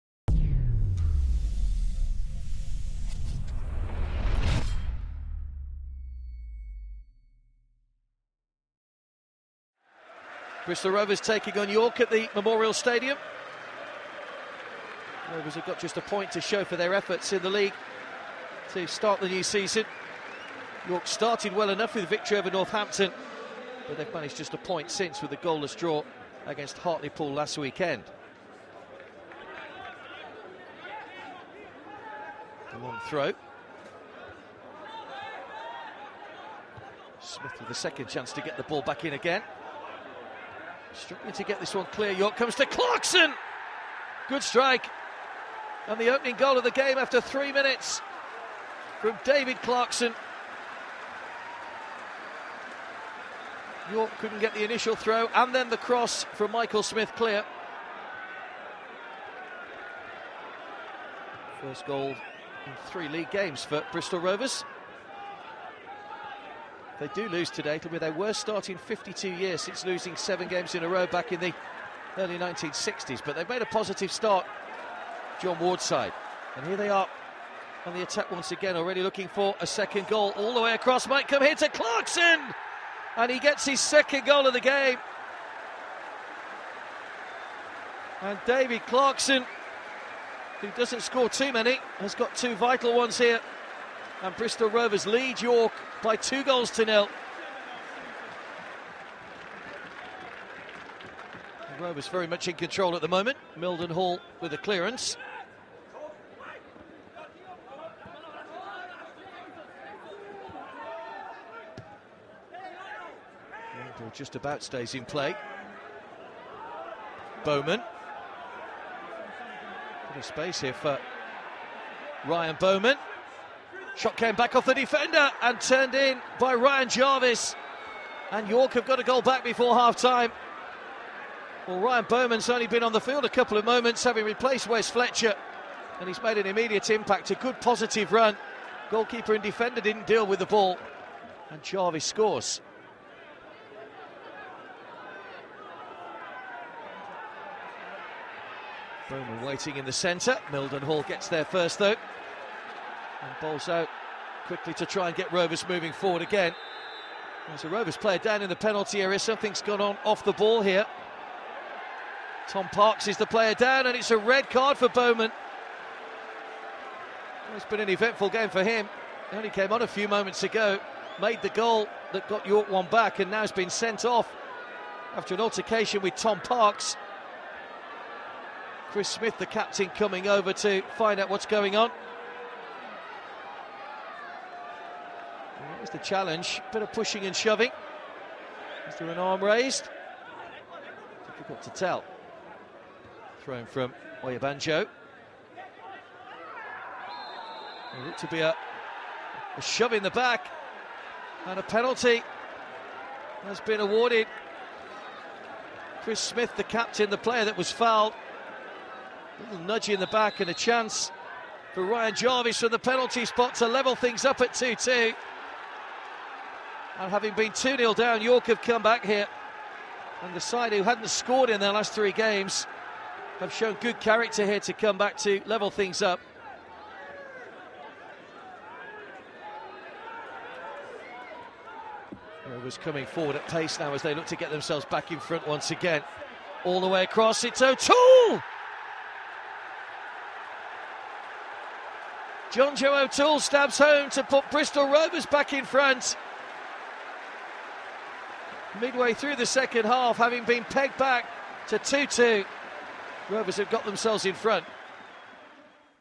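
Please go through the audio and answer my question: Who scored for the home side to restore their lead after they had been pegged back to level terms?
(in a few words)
John Joe O'Toole.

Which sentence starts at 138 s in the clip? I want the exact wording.
Goalkeeper and defender didn't deal with the ball, and Jarvis scores.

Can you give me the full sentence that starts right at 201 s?
And a penalty has been awarded.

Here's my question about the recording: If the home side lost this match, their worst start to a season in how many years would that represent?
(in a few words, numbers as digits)
52.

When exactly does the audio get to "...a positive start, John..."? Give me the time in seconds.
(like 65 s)
73 s.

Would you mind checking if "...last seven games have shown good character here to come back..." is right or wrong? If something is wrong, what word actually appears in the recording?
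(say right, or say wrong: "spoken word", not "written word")
wrong: "three", not "seven".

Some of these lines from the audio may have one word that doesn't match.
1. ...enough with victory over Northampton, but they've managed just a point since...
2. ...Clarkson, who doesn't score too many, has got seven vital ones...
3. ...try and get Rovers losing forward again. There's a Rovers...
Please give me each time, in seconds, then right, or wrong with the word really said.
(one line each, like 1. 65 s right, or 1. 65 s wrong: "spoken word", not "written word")
1. 21 s right
2. 88 s wrong: "two", not "seven"
3. 154 s wrong: "moving", not "losing".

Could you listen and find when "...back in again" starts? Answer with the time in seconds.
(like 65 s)
38 s.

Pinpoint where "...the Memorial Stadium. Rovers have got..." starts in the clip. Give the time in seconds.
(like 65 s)
12 s.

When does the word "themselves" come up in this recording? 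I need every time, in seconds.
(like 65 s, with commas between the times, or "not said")
234 s, 253 s.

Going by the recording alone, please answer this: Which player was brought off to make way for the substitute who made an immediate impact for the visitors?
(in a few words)
Wes Fletcher.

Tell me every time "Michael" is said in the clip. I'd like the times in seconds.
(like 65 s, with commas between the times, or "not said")
56 s.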